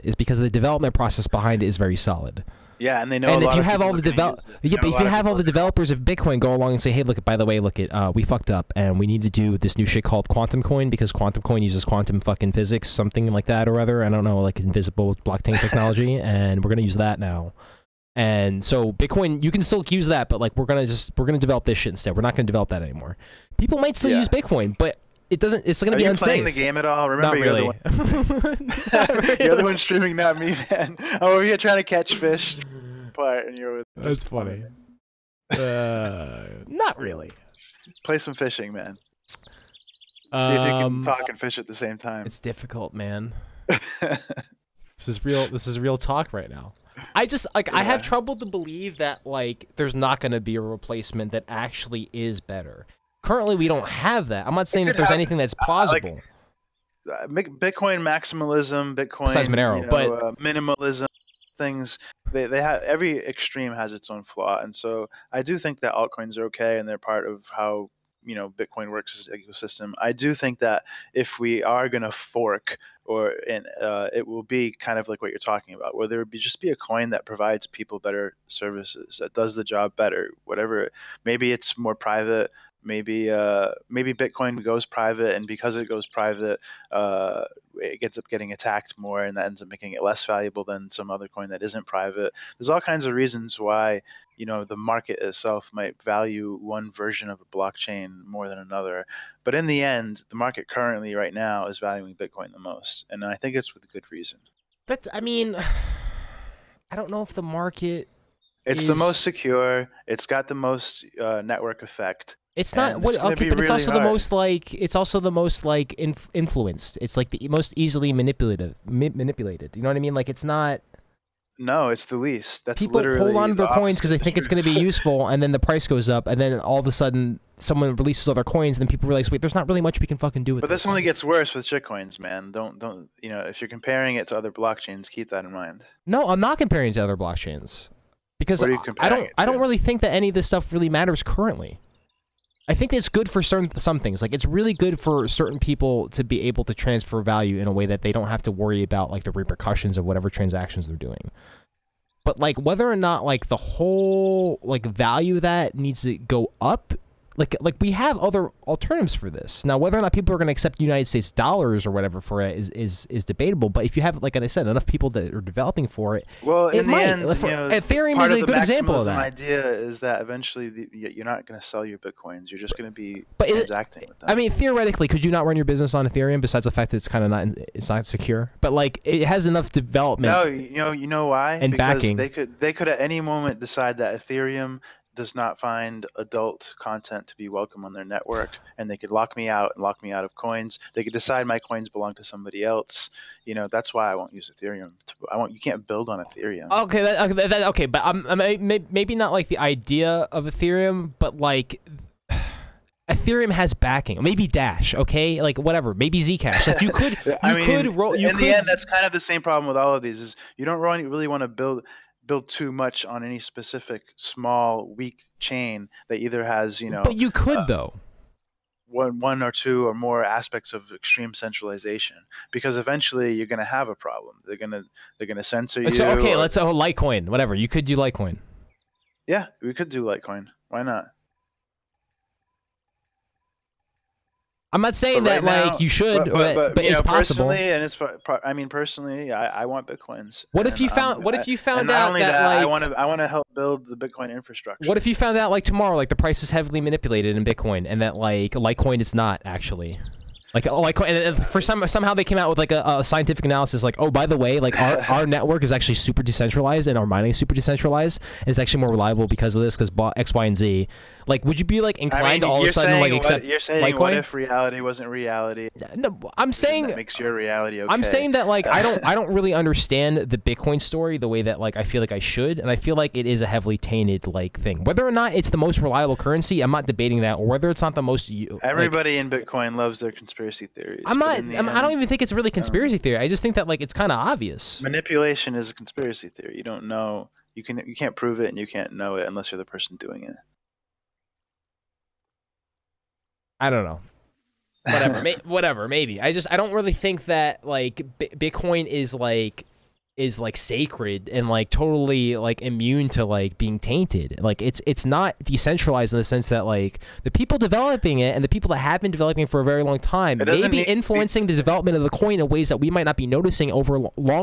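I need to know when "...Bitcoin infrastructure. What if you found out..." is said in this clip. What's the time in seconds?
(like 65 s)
243 s.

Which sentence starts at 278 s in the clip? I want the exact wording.
Everybody like, in Bitcoin loves their conspiracy theories.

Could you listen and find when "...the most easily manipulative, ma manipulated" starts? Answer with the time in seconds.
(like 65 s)
117 s.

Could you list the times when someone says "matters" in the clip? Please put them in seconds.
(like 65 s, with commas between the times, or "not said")
140 s.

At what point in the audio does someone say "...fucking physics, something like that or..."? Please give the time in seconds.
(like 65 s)
12 s.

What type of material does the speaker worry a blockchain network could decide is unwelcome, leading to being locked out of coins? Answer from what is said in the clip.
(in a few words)
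adult content.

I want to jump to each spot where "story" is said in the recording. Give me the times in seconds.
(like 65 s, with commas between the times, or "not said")
270 s.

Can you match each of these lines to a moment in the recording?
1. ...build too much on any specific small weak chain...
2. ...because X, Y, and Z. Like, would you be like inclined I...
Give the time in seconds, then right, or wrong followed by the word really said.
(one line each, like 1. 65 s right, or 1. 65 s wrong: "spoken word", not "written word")
1. 212 s right
2. 259 s right.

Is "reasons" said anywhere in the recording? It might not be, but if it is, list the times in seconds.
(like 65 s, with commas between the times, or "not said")
93 s, 104 s.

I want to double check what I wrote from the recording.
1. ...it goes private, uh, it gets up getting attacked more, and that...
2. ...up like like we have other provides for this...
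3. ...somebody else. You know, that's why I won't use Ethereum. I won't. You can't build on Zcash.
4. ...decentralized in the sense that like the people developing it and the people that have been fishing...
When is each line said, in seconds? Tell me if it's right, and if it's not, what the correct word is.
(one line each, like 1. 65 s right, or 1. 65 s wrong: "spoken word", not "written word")
1. 85 s right
2. 156 s wrong: "alternatives", not "provides"
3. 192 s wrong: "Ethereum", not "Zcash"
4. 305 s wrong: "developing", not "fishing".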